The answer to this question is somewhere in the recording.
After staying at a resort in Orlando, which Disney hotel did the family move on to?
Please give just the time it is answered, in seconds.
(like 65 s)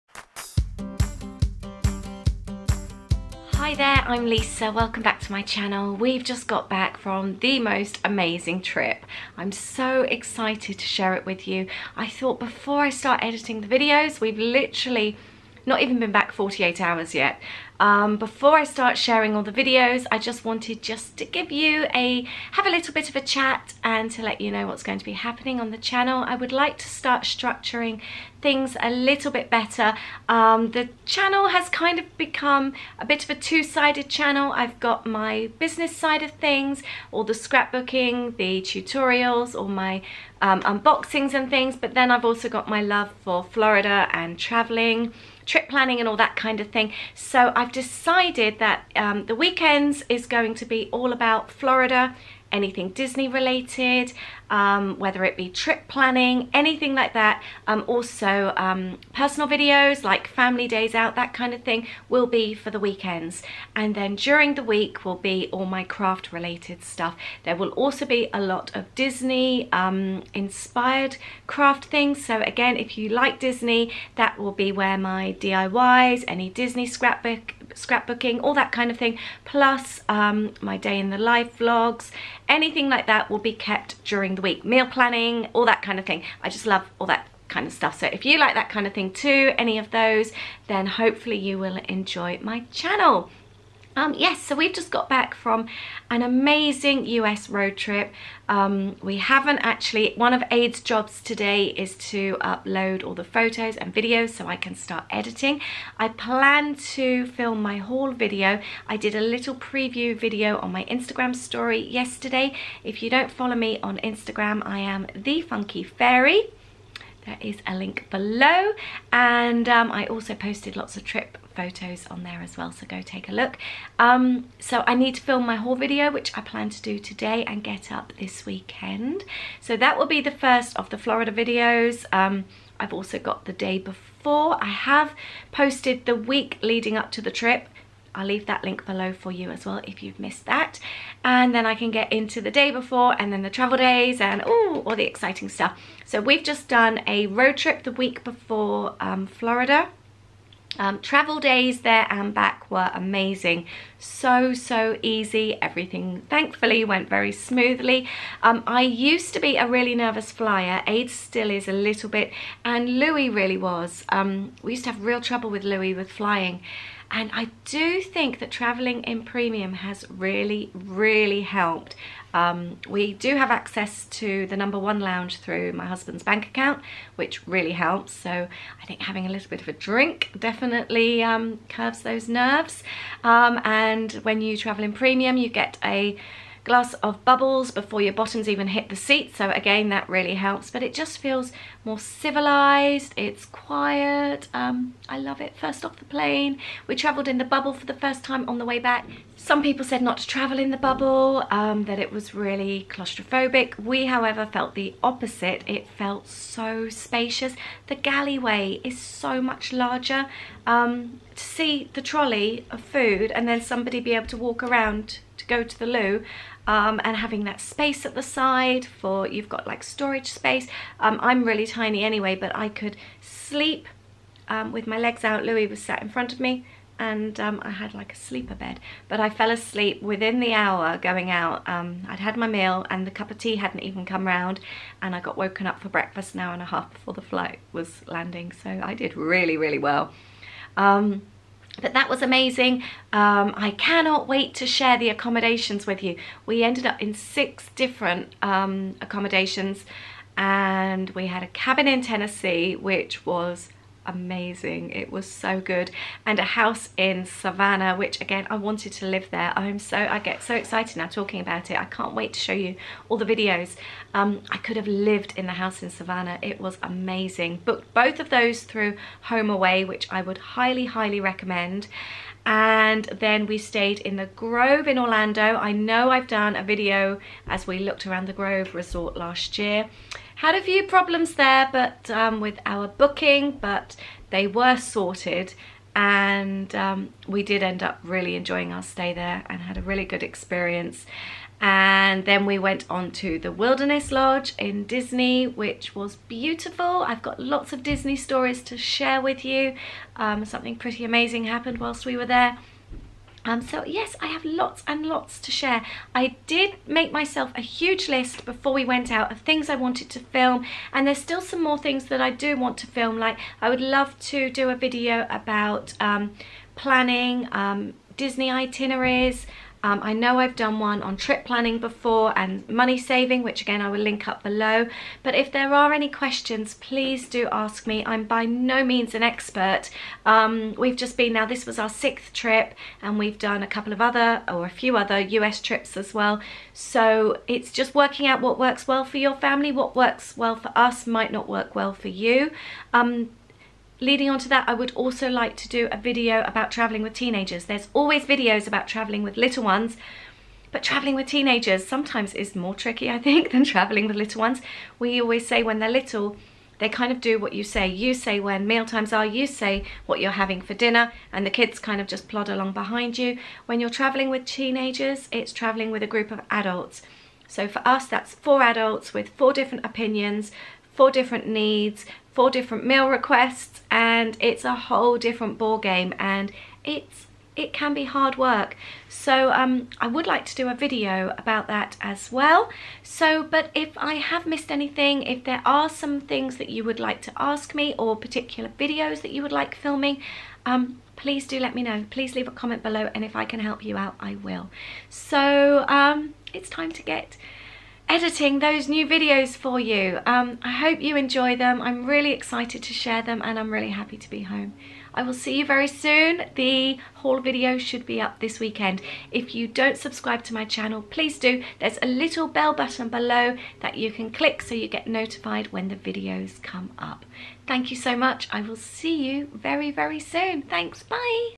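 293 s.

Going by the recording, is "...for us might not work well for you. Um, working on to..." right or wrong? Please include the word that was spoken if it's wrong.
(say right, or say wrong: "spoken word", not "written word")
wrong: "leading", not "working".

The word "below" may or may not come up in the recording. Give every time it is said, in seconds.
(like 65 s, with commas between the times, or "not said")
118 s, 138 s, 324 s, 392 s, 413 s.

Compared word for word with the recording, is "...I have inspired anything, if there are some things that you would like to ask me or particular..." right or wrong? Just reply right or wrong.
wrong.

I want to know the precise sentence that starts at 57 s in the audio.
Um, also um, personal videos like family days out, that kind of thing will be for the weekends.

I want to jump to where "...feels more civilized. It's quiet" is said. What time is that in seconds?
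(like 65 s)
191 s.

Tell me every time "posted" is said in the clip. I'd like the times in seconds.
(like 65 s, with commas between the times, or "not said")
120 s, 135 s.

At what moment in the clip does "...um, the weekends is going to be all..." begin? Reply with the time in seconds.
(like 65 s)
48 s.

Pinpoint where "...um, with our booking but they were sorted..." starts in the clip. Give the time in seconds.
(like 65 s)
282 s.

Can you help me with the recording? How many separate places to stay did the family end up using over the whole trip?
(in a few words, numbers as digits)
6.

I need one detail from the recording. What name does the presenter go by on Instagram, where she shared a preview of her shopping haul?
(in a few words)
the Funky Fairy.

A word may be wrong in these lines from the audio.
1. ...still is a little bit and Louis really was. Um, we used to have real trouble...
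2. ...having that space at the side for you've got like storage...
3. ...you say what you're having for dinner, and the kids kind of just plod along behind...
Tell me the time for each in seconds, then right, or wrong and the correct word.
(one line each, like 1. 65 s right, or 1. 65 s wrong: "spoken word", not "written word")
1. 161 s right
2. 217 s right
3. 359 s right.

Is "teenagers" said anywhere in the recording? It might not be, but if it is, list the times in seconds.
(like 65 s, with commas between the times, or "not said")
347 s, 351 s, 364 s.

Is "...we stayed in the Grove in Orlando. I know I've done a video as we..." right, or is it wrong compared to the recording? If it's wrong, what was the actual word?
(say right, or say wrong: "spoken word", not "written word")
right.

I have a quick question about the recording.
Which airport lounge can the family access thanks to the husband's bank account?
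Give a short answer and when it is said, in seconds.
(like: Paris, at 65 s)
the number one lounge, at 174 s.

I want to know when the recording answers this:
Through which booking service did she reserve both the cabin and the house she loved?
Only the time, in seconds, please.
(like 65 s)
269 s.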